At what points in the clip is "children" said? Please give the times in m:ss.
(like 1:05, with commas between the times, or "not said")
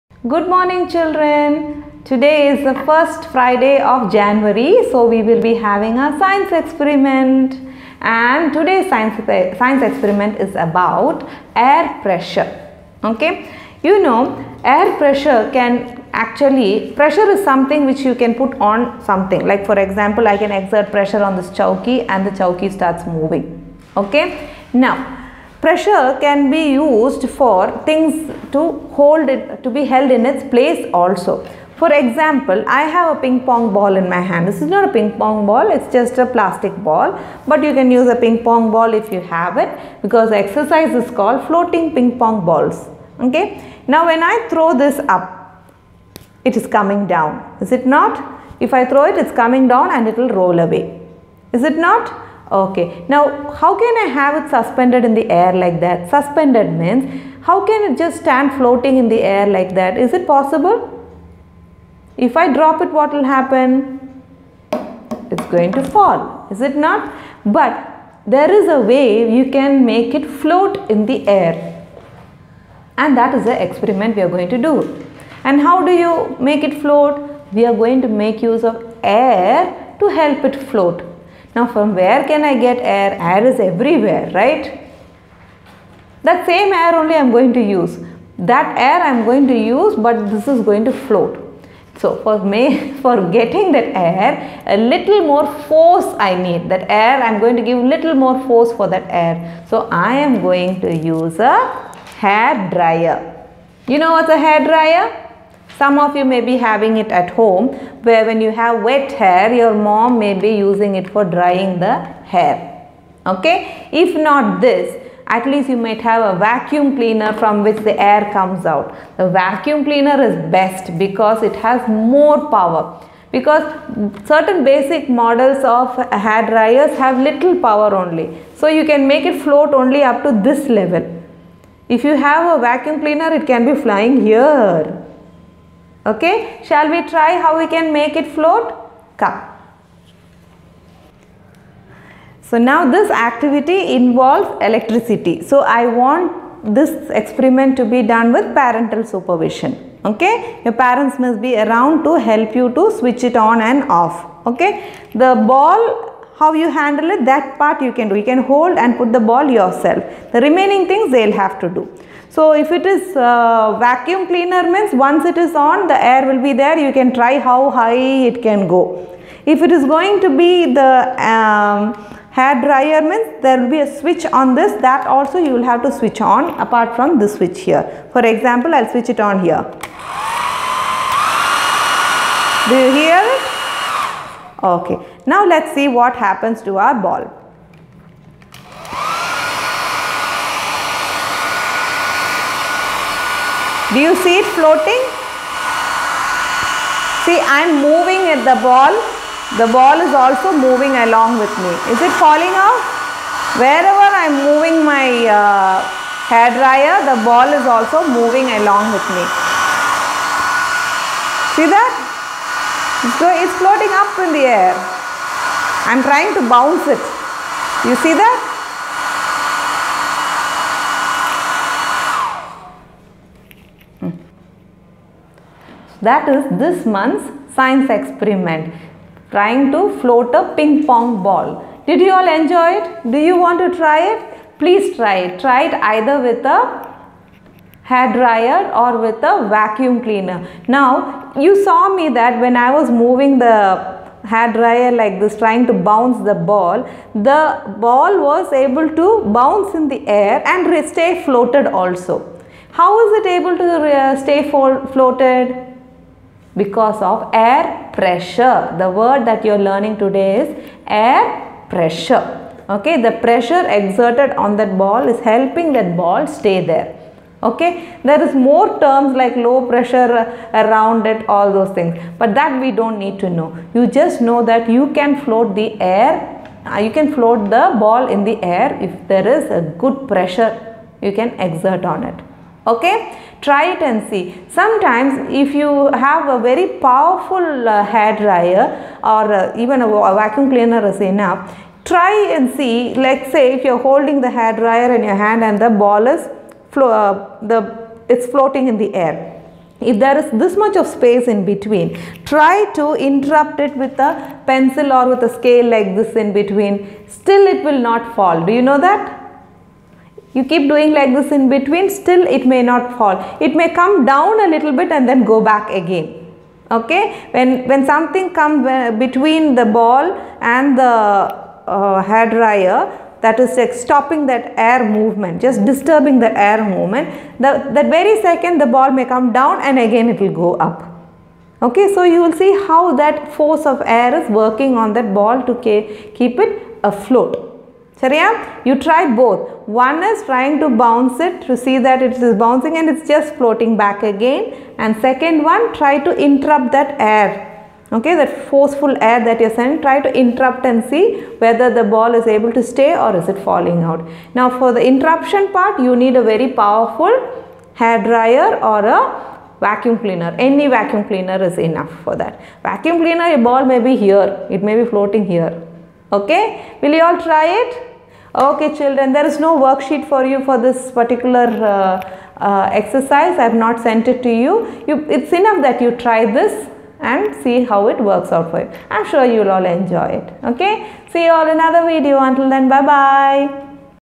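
0:00, 6:08.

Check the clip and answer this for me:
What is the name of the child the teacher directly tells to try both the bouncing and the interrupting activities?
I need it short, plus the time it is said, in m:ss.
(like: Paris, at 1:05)
Sariya, at 5:37.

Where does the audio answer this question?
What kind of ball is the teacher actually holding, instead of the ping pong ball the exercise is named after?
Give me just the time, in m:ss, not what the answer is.
0:36.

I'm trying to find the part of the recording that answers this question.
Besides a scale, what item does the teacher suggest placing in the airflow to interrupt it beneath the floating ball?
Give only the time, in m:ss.
5:04.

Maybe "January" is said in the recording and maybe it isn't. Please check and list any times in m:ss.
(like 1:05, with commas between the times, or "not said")
0:04.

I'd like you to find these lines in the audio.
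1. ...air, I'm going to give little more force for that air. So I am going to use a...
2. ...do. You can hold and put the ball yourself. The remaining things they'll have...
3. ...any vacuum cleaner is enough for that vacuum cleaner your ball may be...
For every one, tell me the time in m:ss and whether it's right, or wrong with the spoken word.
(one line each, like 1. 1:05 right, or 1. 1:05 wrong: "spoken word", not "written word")
1. 1:36 right
2. 2:38 right
3. 6:00 right.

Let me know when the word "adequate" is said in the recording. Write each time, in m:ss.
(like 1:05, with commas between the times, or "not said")
not said.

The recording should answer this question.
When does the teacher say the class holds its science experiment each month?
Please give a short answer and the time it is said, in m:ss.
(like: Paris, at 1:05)
First Friday, at 0:02.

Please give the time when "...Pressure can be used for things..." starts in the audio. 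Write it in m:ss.
0:25.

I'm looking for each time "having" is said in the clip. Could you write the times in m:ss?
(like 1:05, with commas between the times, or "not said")
0:05, 1:46.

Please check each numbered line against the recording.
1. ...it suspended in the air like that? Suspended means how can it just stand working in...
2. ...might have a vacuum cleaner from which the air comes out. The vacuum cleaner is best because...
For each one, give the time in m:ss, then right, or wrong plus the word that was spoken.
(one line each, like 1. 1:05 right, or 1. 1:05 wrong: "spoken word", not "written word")
1. 0:54 wrong: "floating", not "working"
2. 1:55 right.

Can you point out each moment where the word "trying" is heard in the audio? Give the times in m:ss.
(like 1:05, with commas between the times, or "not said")
3:36, 3:49, 4:05, 5:40.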